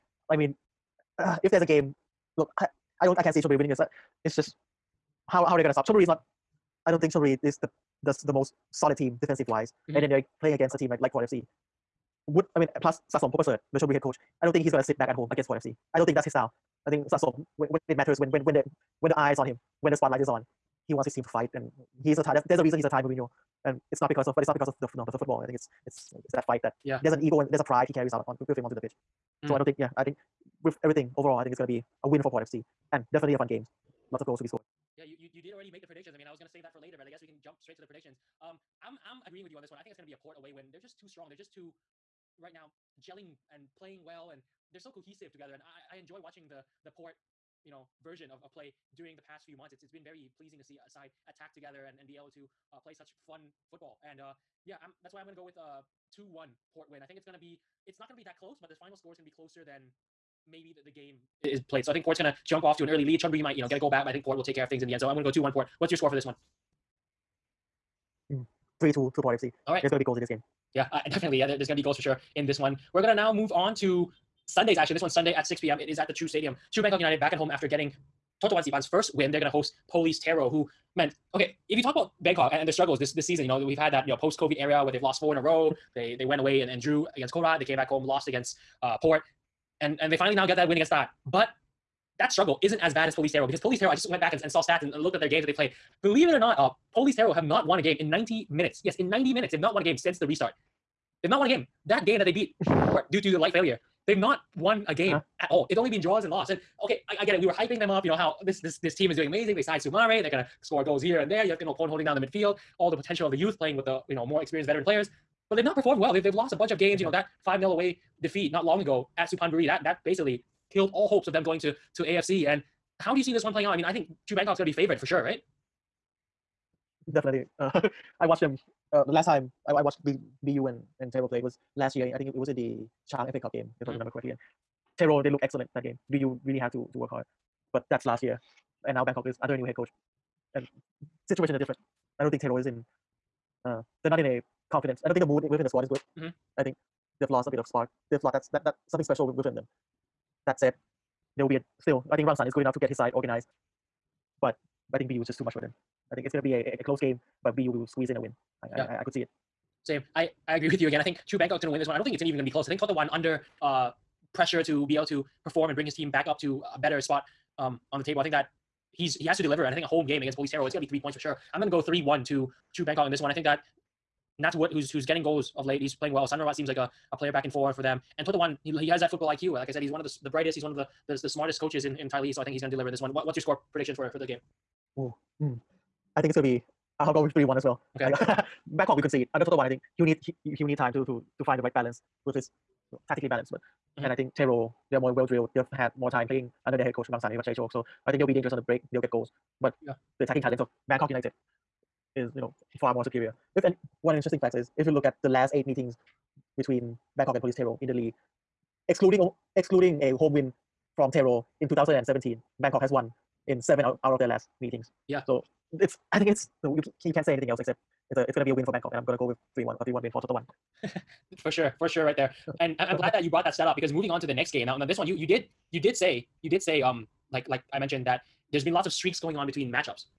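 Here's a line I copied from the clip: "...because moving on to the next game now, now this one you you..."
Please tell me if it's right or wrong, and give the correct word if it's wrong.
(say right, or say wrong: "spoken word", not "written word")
right.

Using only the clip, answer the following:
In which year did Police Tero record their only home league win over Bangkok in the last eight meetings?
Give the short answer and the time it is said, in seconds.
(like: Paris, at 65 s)
2017, at 211 s.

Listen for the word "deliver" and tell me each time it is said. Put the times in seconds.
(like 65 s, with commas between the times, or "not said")
169 s, 182 s.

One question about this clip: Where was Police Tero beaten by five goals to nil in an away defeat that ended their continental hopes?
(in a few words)
Supanburi.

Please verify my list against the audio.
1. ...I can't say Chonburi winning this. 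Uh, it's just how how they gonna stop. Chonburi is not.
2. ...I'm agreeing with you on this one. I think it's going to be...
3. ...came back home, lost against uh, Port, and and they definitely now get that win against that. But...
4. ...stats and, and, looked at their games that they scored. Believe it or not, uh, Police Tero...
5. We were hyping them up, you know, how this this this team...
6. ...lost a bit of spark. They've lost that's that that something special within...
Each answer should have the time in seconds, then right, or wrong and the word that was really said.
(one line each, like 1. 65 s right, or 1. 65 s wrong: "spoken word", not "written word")
1. 3 s right
2. 39 s right
3. 87 s wrong: "finally", not "definitely"
4. 94 s wrong: "played", not "scored"
5. 107 s right
6. 147 s right.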